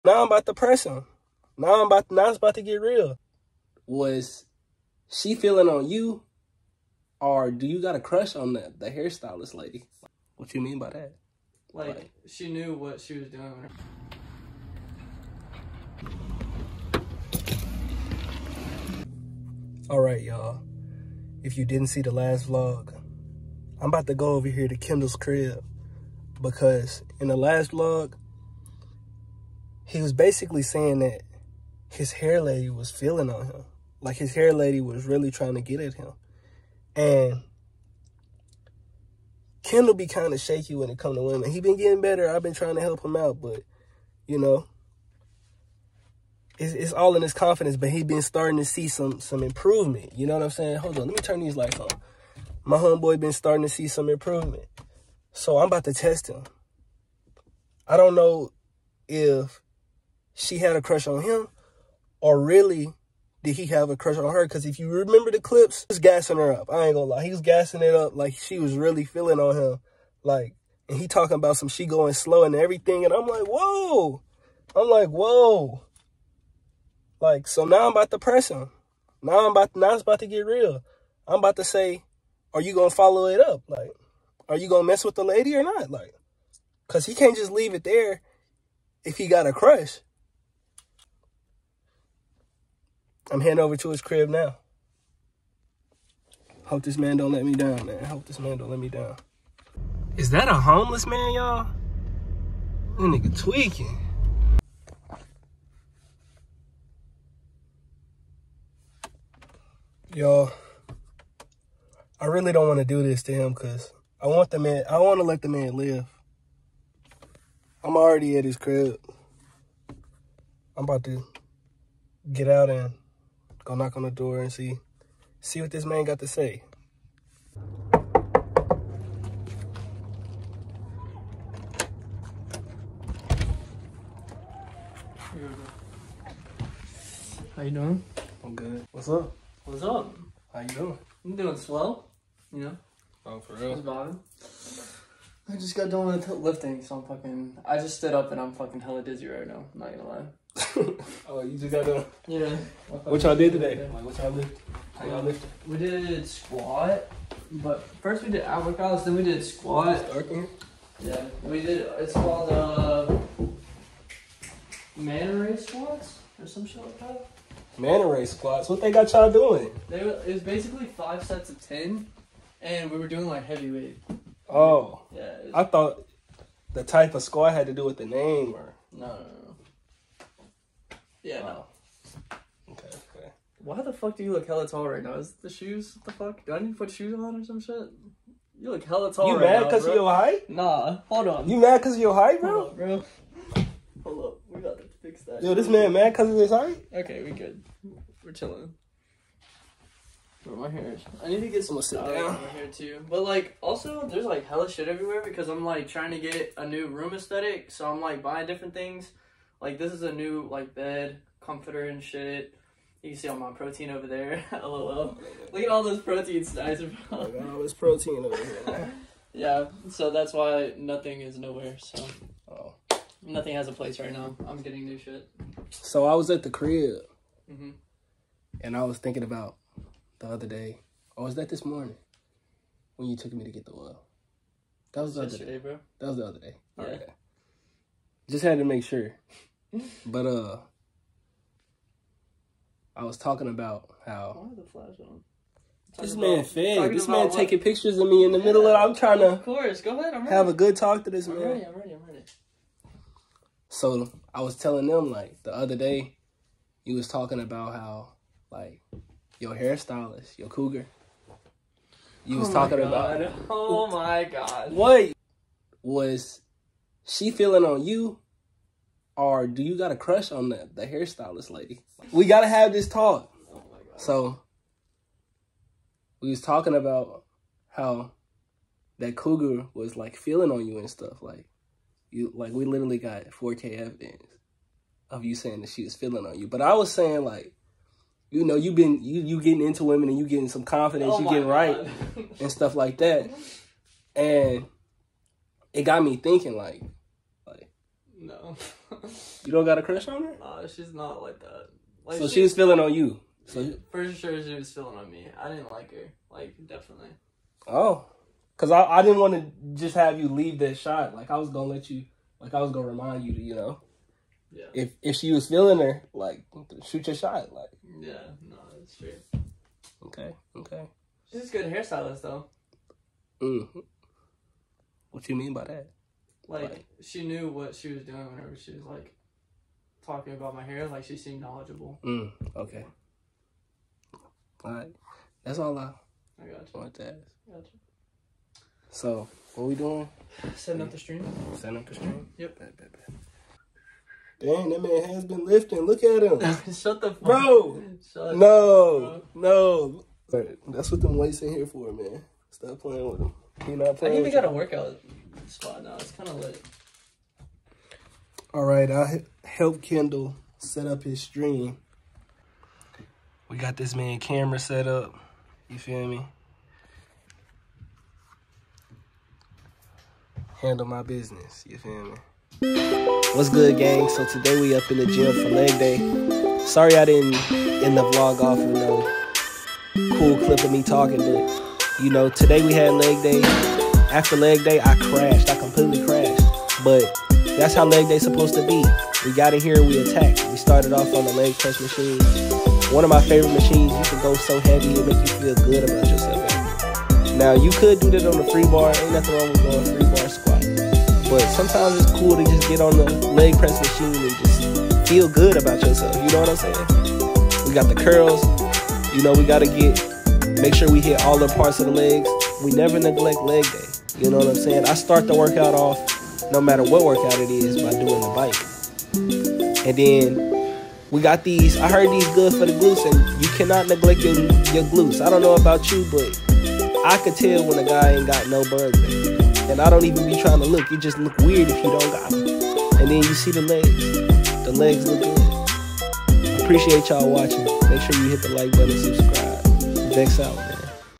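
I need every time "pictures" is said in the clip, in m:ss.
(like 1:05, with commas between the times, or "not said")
4:07.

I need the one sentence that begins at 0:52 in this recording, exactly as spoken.
My homeboy been starting to see some improvement, so I'm about to test him.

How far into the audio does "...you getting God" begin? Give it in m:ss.
4:51.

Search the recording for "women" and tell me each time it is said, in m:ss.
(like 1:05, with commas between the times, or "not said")
0:41, 4:49.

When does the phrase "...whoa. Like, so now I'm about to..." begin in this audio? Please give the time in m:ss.
1:15.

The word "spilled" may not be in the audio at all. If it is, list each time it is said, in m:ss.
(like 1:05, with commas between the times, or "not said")
not said.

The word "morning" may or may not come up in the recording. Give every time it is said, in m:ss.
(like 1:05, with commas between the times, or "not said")
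3:51.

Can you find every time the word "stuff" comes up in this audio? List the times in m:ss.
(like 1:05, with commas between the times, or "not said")
3:21, 4:40, 4:52.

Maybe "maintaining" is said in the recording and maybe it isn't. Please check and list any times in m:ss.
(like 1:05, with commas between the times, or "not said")
not said.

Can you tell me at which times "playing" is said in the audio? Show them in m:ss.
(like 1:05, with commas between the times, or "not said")
5:52.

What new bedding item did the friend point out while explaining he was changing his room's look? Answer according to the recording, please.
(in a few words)
Bed comforter.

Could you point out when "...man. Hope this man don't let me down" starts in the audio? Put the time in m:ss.
1:37.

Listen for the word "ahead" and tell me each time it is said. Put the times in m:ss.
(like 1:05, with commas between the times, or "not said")
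4:09.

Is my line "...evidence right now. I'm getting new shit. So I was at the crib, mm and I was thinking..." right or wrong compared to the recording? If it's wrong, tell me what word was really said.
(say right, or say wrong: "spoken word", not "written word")
wrong: "place", not "evidence".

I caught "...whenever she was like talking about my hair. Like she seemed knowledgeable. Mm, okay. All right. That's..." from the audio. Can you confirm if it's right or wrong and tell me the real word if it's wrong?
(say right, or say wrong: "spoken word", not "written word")
right.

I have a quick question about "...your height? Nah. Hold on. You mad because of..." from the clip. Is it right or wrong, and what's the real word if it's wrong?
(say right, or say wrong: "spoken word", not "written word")
right.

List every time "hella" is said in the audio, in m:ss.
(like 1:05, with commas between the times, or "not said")
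2:28, 3:04, 3:08, 3:24.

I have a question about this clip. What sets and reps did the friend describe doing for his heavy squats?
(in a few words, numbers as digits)
5 sets of 10.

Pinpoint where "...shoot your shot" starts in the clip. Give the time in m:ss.
5:16.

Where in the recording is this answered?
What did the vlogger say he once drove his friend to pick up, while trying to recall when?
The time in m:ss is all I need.
3:53.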